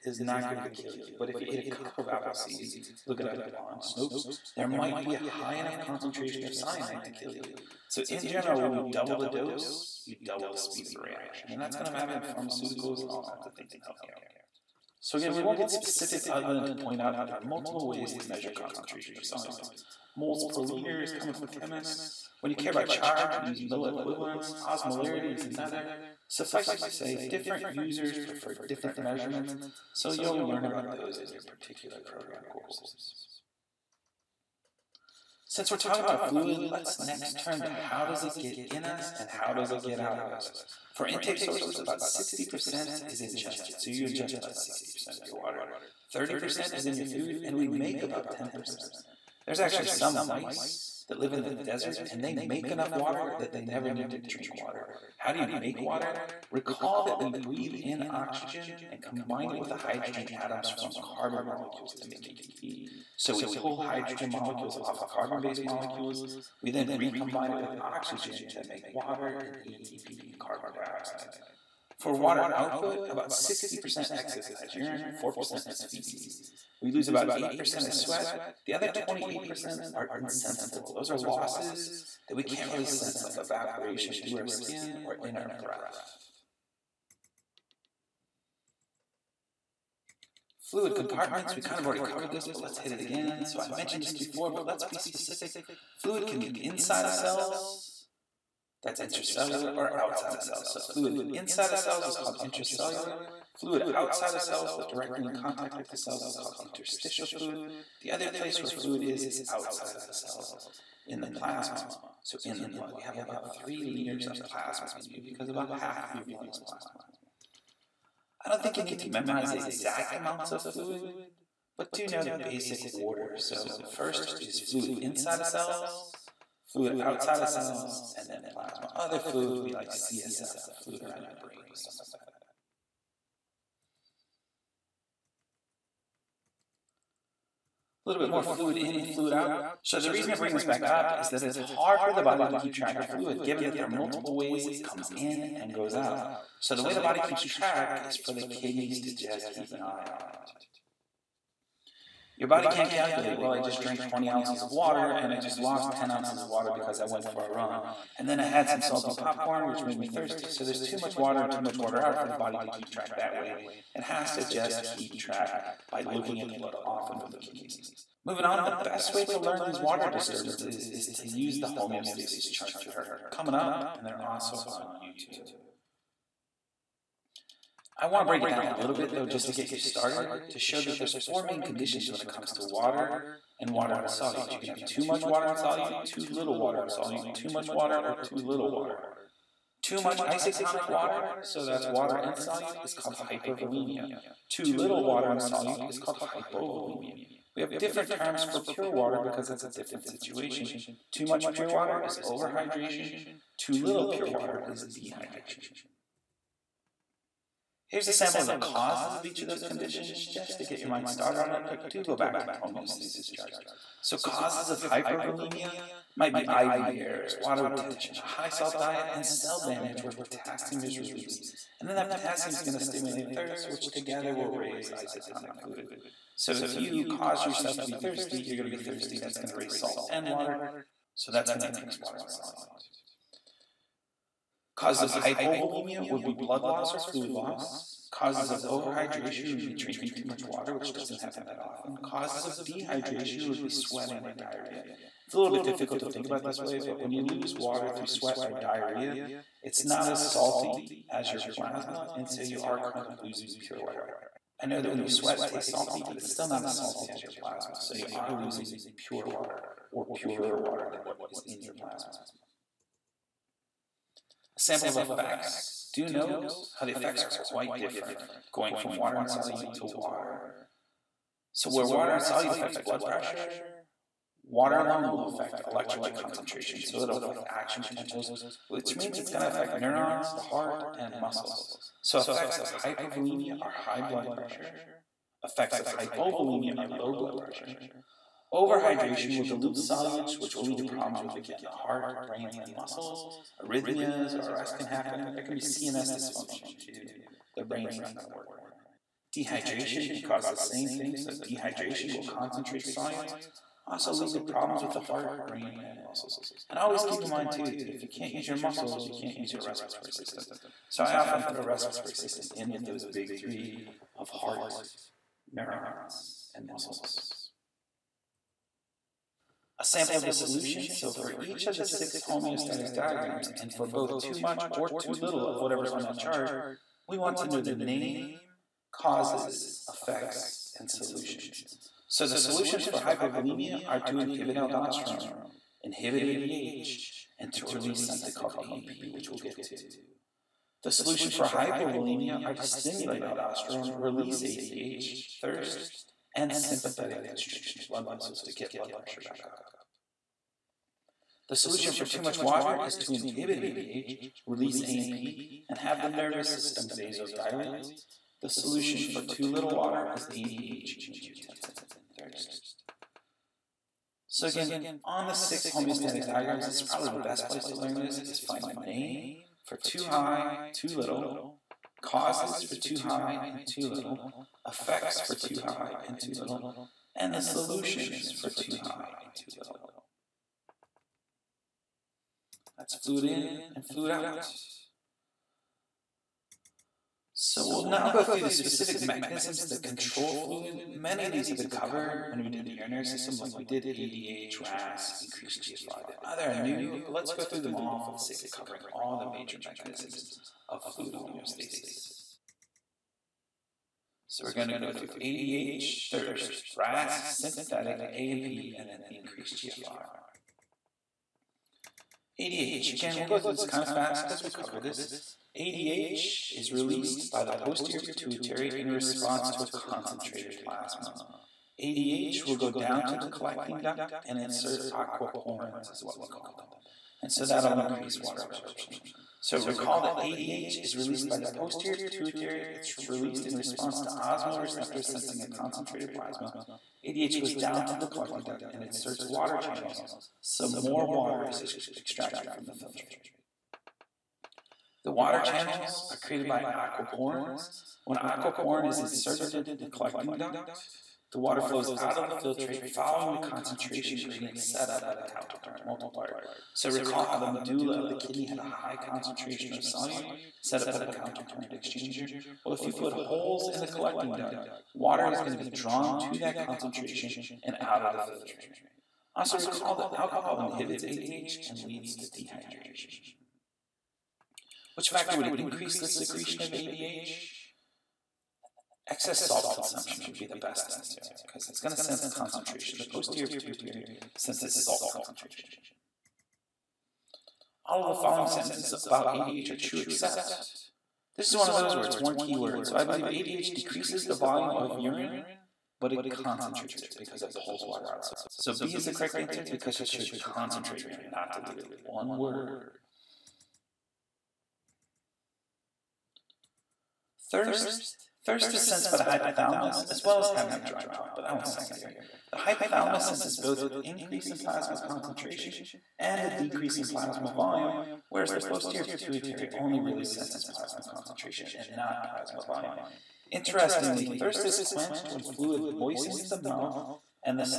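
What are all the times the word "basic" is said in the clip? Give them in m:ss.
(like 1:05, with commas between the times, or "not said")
2:02.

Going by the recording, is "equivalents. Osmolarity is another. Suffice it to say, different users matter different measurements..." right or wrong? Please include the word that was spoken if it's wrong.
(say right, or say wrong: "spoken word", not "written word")
wrong: "prefer", not "matter".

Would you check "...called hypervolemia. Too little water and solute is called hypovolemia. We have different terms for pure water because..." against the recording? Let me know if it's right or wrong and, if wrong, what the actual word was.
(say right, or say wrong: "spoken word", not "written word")
right.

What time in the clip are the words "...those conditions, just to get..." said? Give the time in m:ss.
3:29.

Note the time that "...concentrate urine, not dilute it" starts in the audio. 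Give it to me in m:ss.
8:20.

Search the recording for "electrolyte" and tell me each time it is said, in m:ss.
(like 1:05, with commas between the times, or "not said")
4:35.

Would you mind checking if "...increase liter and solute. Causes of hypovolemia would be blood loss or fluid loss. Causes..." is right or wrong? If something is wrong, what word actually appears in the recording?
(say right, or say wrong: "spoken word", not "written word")
wrong: "water", not "liter".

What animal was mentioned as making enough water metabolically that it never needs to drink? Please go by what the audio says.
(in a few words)
mice.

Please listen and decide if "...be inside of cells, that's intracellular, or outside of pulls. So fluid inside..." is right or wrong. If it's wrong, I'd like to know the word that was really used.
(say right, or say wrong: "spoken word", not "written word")
wrong: "cells", not "pulls".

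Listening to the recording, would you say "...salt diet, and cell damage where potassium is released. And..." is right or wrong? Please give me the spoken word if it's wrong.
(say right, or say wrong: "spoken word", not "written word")
right.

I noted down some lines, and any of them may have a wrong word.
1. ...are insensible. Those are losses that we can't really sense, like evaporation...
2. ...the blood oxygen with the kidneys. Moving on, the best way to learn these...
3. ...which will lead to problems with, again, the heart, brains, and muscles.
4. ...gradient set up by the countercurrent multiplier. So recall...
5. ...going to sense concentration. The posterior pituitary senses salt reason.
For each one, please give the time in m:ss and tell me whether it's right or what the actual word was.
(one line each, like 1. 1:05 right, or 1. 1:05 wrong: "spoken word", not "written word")
1. 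1:19 right
2. 2:46 wrong: "often", not "oxygen"
3. 4:50 right
4. 7:34 right
5. 8:01 wrong: "concentration", not "reason".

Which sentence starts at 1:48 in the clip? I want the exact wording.
The other place where fluid is is outside of the cells in the plasma, so in the blood.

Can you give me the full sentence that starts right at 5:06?
And always keep in mind, too, that if you can't use your muscles, you can't use your respiratory system.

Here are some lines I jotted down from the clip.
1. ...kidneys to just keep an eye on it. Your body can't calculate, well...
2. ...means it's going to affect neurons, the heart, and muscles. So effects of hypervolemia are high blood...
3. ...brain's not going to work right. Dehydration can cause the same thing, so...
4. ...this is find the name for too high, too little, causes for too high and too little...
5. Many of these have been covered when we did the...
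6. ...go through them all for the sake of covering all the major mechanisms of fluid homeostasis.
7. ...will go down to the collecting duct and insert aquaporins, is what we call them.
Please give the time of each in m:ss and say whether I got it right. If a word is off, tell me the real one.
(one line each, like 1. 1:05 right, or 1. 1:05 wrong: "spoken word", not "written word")
1. 2:28 right
2. 4:38 right
3. 4:57 right
4. 6:07 right
5. 6:30 right
6. 6:37 right
7. 7:02 right.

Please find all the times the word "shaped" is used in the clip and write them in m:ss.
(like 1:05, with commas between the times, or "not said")
not said.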